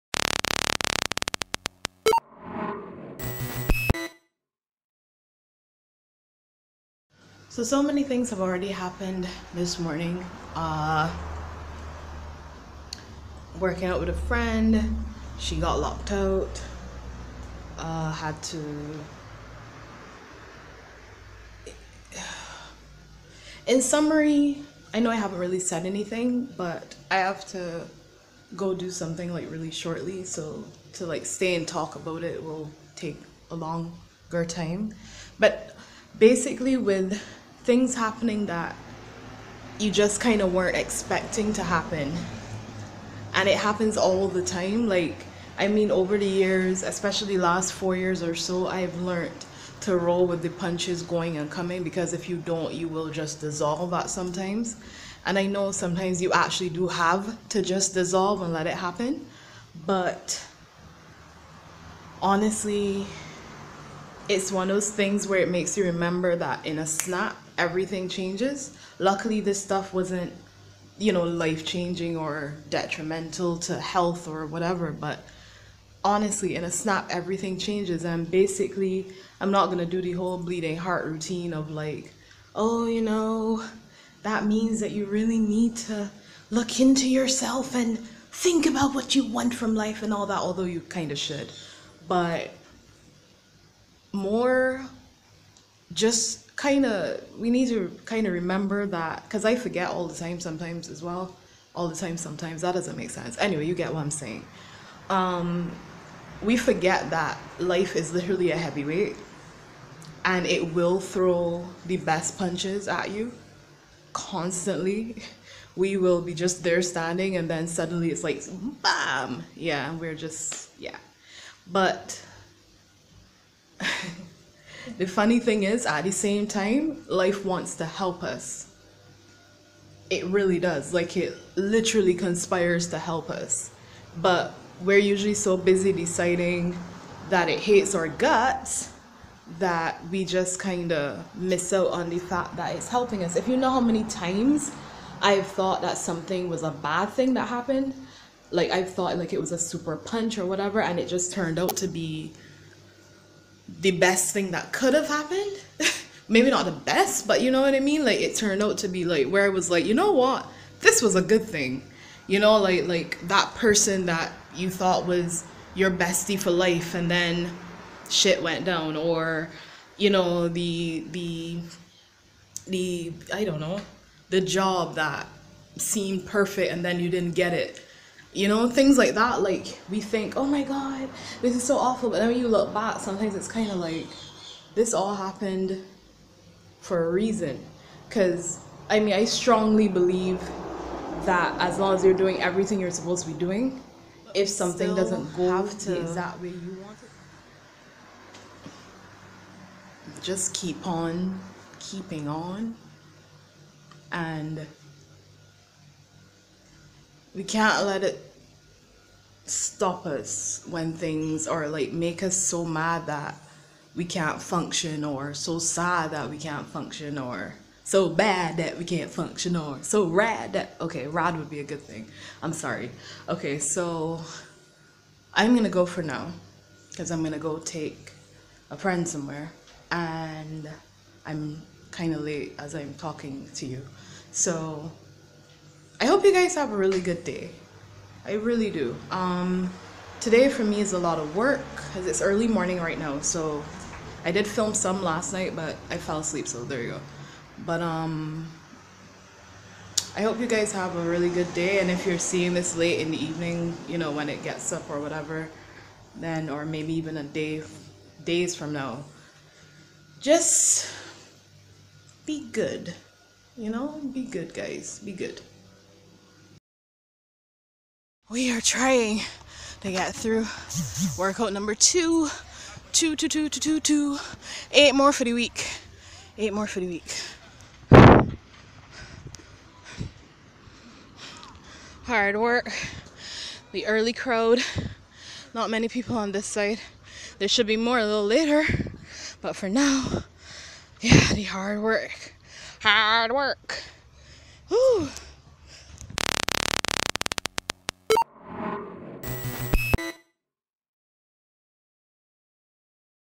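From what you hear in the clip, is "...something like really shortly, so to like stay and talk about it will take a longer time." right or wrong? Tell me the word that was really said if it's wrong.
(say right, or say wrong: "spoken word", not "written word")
right.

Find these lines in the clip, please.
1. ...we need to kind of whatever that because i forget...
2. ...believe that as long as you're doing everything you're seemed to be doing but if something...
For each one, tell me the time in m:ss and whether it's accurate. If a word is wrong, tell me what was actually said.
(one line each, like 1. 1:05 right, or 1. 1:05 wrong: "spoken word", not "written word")
1. 1:37 wrong: "remember", not "whatever"
2. 3:09 wrong: "supposed", not "seemed".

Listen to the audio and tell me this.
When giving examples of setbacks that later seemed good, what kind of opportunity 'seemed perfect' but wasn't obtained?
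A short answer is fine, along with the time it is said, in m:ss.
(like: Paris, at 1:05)
the job, at 2:54.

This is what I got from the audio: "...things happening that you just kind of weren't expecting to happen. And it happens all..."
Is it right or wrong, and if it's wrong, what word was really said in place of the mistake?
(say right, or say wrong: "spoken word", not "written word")
right.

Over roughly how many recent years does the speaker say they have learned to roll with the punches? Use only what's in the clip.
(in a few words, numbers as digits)
4 years.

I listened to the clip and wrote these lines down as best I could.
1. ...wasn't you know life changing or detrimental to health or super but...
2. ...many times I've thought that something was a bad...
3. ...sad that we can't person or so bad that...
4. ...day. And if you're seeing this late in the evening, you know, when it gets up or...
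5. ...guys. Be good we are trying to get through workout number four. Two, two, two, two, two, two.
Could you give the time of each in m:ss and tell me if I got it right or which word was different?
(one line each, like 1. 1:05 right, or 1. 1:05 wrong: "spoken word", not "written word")
1. 1:09 wrong: "whatever", not "super"
2. 2:23 right
3. 3:35 wrong: "function", not "person"
4. 4:11 right
5. 4:24 wrong: "two", not "four".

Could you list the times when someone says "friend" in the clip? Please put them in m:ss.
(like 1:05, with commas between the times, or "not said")
0:14, 3:48.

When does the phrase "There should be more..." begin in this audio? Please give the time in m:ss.
4:47.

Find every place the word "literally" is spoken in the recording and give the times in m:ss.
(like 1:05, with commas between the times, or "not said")
1:48, 2:11.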